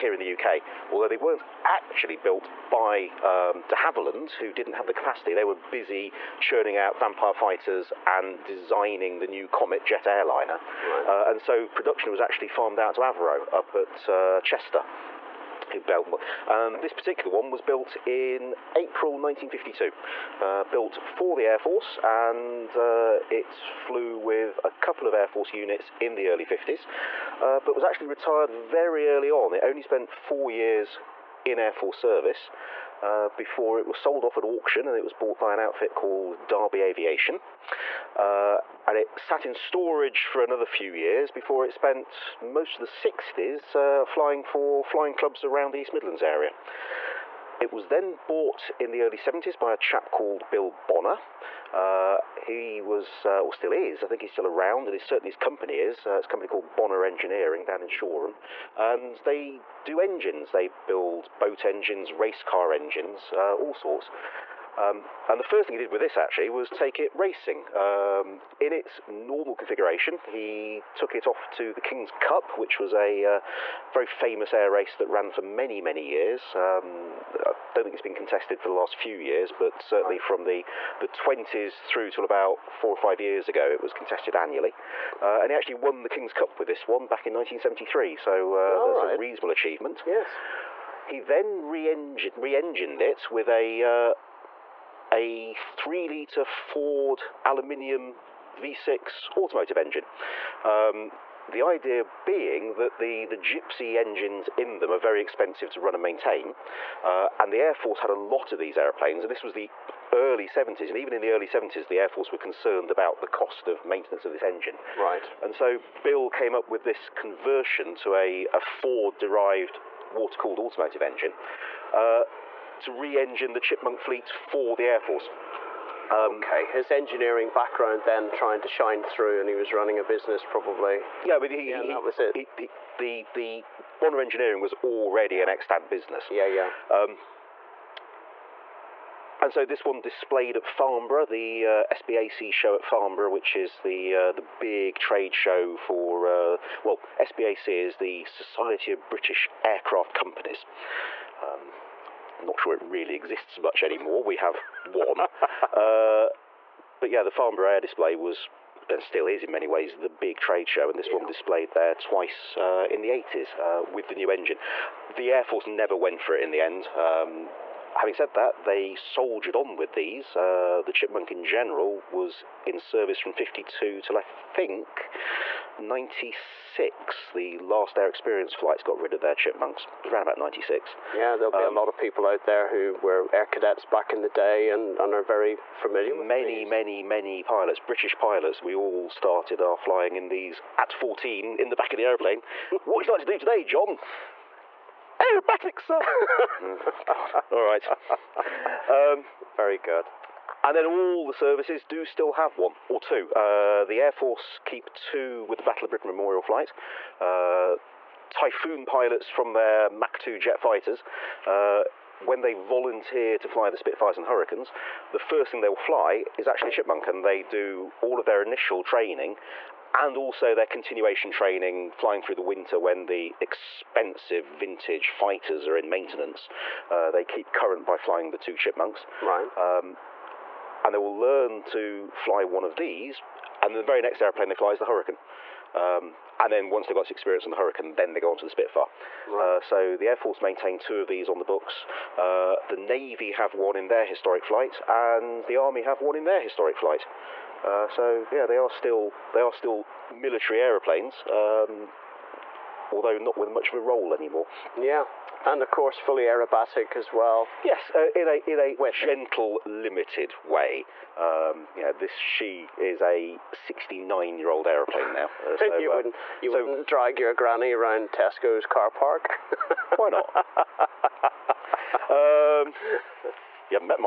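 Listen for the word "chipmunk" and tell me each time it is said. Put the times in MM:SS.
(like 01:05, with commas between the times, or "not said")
02:03, 02:50, 02:59, 03:36, 03:48.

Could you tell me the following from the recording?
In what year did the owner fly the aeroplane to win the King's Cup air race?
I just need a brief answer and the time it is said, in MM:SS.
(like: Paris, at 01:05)
1973, at 01:27.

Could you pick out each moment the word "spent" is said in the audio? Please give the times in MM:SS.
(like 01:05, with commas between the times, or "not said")
00:29, 00:41.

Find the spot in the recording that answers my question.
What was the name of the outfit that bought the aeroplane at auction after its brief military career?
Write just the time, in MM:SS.
00:36.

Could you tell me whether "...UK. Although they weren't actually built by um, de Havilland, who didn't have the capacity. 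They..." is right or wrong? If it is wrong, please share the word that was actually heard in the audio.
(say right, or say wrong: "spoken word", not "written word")
right.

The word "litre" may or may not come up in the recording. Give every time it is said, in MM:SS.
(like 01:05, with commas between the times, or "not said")
01:36.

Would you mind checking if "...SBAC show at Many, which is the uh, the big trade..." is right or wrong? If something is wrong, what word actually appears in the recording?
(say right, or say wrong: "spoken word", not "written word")
wrong: "Farnborough", not "Many".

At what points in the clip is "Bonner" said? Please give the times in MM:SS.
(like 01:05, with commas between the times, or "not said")
00:50, 00:56, 02:13.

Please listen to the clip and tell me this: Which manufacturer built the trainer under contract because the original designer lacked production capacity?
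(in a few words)
Avro.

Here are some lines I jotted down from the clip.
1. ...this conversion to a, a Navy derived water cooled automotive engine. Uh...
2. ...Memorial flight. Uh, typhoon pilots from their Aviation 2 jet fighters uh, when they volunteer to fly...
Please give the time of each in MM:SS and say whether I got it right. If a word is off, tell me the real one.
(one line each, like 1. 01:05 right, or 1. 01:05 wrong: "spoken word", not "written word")
1. 01:56 wrong: "Ford", not "Navy"
2. 03:26 wrong: "Mach", not "Aviation".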